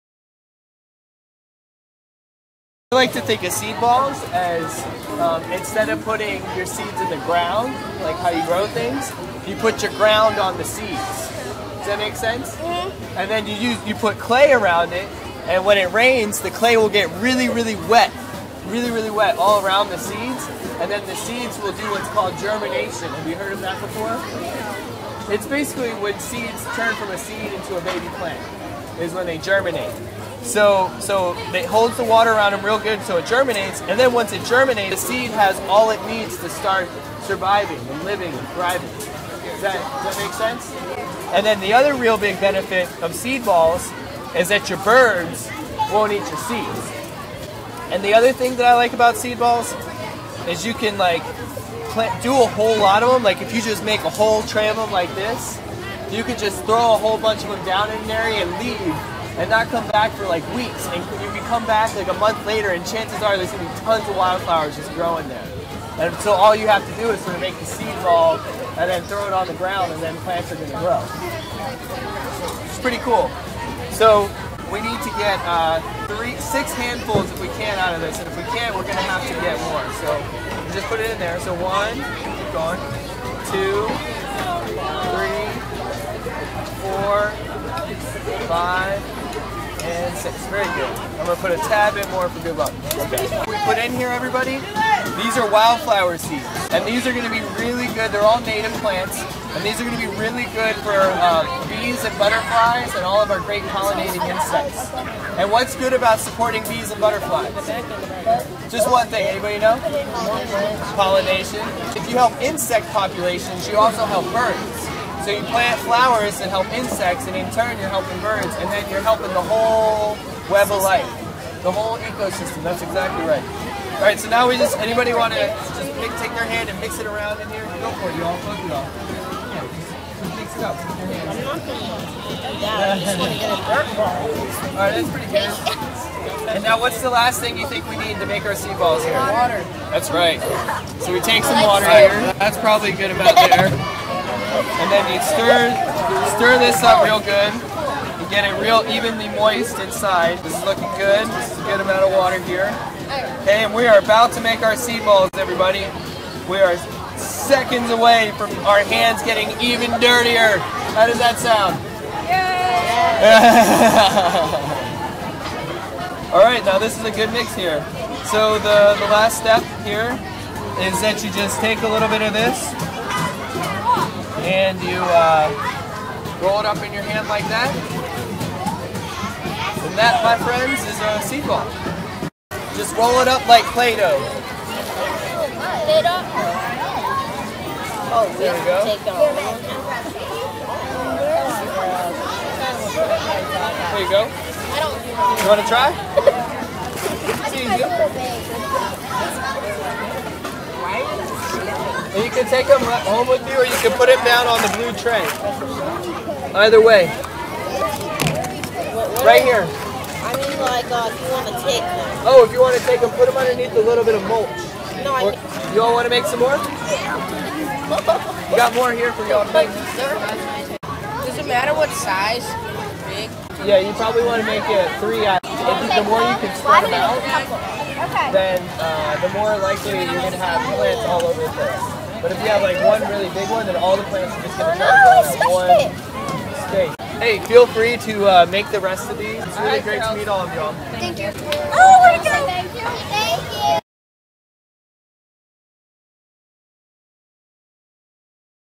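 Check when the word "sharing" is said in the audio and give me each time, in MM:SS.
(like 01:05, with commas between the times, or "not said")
not said.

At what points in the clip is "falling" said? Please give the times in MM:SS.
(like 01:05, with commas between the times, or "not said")
not said.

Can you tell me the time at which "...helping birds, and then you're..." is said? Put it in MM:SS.
01:57.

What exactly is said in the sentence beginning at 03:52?
But if you have like one really big one, then all the plants are just going to turn one state.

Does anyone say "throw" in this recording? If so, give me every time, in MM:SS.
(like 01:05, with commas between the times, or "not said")
00:56, 01:09.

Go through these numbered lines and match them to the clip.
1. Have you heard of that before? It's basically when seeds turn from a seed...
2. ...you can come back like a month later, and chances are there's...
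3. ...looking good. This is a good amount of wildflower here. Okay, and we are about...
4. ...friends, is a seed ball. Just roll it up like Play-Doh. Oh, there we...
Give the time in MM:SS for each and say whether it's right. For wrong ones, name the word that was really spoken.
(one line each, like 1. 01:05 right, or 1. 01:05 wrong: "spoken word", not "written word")
1. 00:23 right
2. 01:01 right
3. 02:30 wrong: "water", not "wildflower"
4. 03:00 right.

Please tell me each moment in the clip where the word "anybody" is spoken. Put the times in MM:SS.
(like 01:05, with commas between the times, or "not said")
01:49, 02:04.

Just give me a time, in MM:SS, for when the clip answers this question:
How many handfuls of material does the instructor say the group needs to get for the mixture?
01:16.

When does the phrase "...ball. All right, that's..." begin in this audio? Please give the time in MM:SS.
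02:13.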